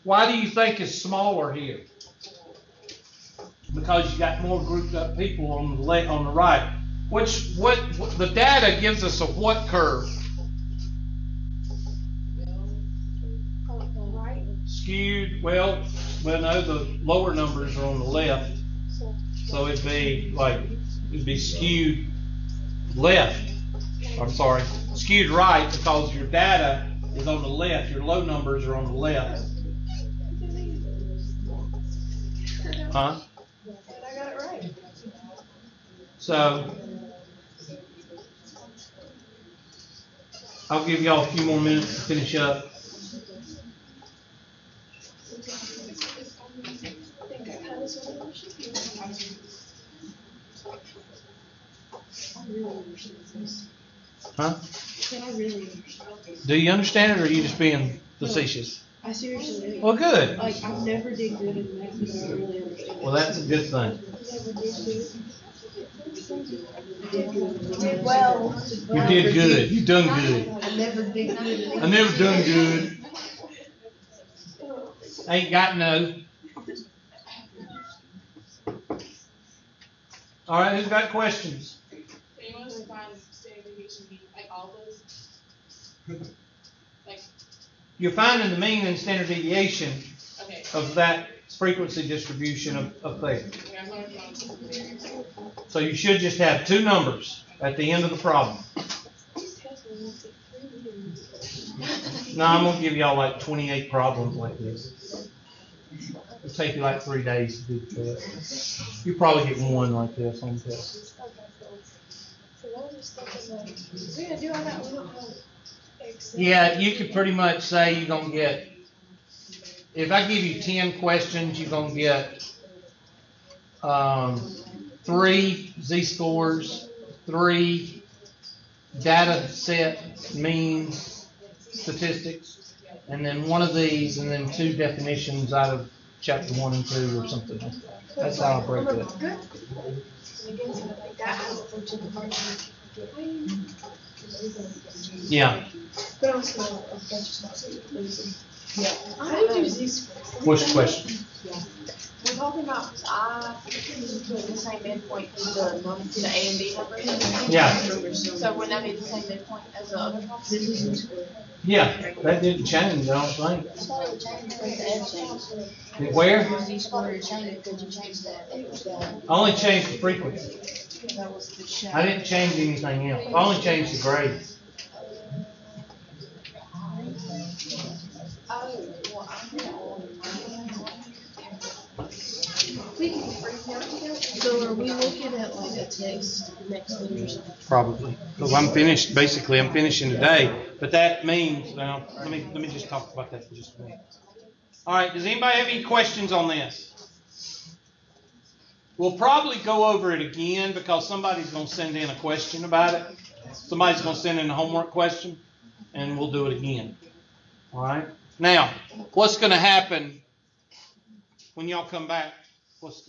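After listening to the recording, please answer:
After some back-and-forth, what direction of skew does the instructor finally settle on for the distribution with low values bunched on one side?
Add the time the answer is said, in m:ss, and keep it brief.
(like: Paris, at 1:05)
skewed right, at 0:24.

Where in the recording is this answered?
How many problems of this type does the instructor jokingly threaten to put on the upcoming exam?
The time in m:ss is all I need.
1:43.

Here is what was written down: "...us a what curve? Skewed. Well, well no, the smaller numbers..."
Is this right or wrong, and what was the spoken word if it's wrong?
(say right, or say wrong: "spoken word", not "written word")
wrong: "lower", not "smaller".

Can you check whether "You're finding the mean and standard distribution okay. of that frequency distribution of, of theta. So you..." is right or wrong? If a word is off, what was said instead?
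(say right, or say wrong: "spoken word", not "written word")
wrong: "deviation", not "distribution".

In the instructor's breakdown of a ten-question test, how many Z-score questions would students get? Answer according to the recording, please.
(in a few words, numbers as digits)
3.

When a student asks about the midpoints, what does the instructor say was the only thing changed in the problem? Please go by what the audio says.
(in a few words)
the frequency.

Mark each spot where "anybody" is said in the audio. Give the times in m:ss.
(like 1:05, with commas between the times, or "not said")
3:15.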